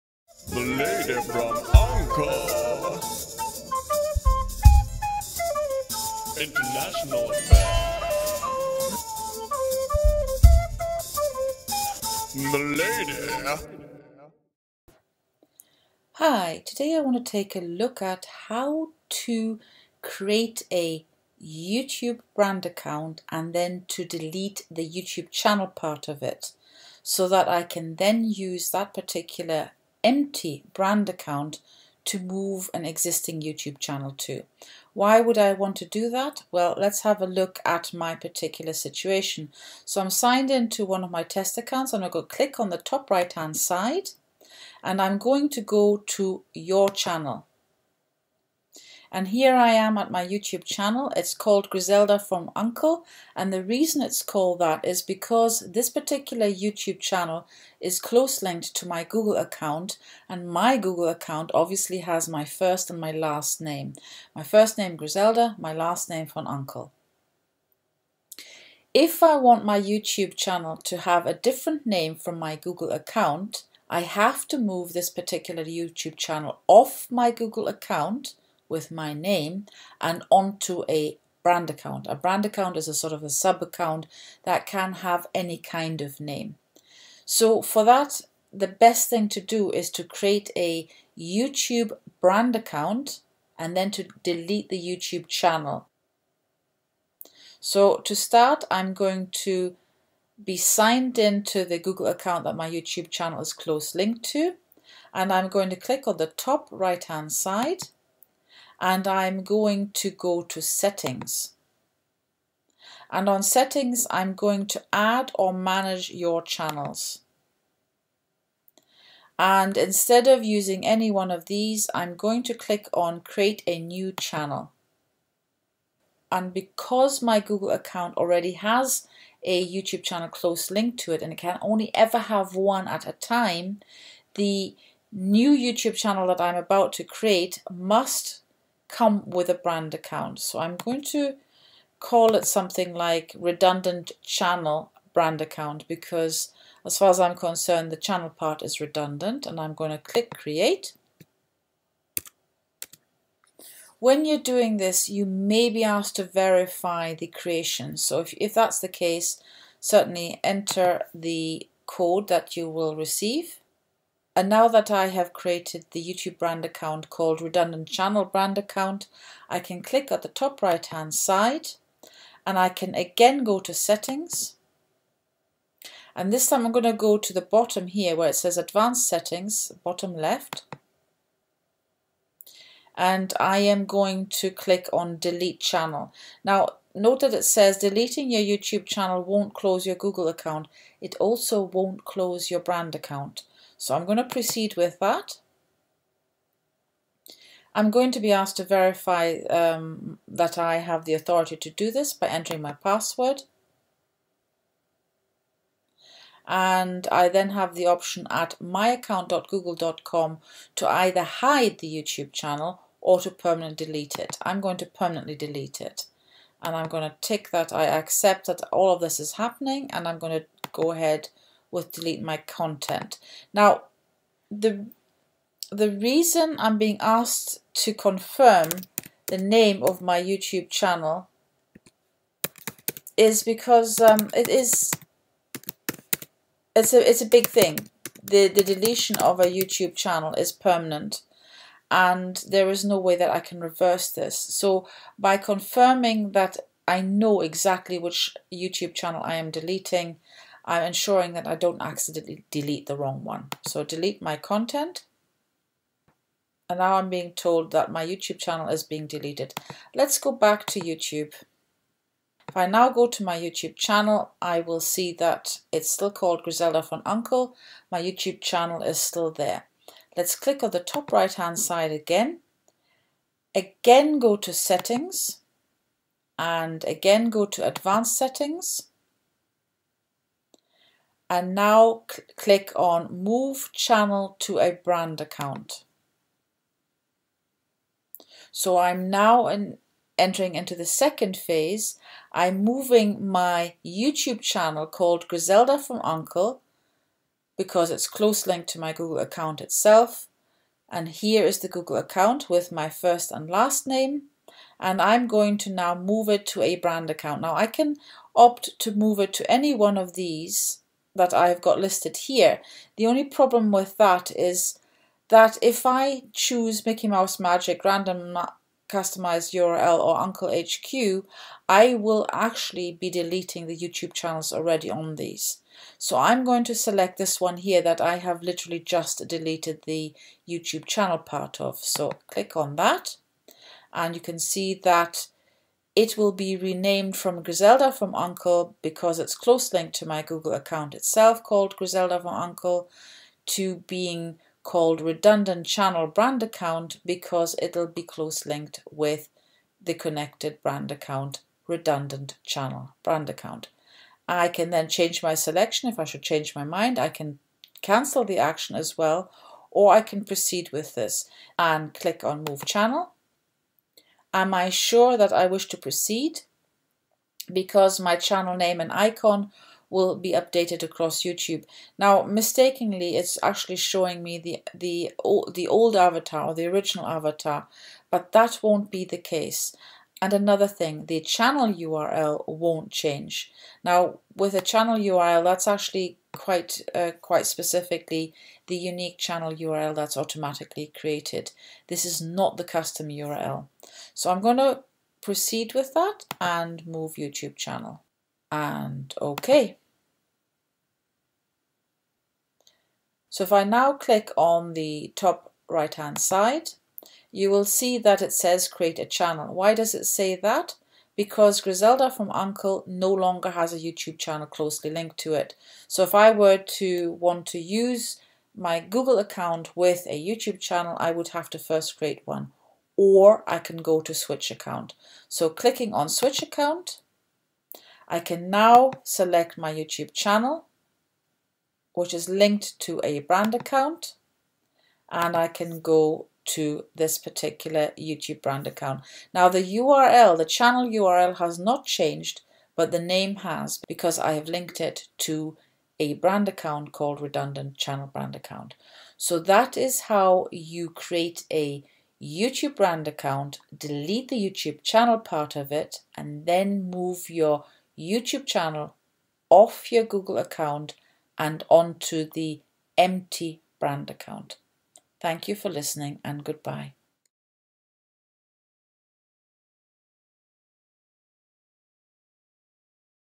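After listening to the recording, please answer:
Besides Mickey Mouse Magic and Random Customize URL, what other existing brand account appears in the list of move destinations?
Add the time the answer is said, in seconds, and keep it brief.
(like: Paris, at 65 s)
Uncle HQ, at 320 s.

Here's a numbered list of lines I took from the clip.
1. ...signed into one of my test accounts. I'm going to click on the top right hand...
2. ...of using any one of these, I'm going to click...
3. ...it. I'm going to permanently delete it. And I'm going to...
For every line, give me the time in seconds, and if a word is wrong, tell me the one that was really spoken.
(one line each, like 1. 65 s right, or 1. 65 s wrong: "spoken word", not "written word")
1. 40 s right
2. 120 s right
3. 214 s right.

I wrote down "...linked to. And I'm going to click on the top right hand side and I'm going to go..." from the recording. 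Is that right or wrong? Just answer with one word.
right.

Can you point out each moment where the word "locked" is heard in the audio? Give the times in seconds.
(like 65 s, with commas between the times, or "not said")
not said.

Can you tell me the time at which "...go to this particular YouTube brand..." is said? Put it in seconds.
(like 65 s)
435 s.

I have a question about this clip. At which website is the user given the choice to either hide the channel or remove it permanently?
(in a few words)
myaccount.google.com.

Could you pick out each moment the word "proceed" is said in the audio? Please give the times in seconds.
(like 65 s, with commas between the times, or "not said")
194 s, 360 s, 365 s, 395 s.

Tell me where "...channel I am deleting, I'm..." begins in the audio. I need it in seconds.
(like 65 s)
248 s.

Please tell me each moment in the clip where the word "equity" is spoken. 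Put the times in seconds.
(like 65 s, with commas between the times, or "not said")
not said.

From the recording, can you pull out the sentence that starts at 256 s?
And now I'm being told that my YouTube channel is being deleted.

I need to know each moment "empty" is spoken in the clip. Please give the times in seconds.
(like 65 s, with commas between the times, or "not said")
30 s, 462 s.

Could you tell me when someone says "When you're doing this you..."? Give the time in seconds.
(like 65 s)
153 s.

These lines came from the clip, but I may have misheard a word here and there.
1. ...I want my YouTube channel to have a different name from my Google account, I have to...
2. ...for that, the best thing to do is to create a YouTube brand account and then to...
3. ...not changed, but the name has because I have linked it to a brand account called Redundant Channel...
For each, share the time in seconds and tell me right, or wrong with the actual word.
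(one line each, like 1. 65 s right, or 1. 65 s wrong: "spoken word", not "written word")
1. 69 s right
2. 87 s right
3. 441 s right.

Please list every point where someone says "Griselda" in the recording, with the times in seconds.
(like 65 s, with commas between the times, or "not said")
51 s, 64 s, 266 s, 295 s, 337 s, 341 s, 411 s.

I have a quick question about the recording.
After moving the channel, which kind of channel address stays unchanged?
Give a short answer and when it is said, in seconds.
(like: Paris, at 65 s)
Unique channel URL, at 388 s.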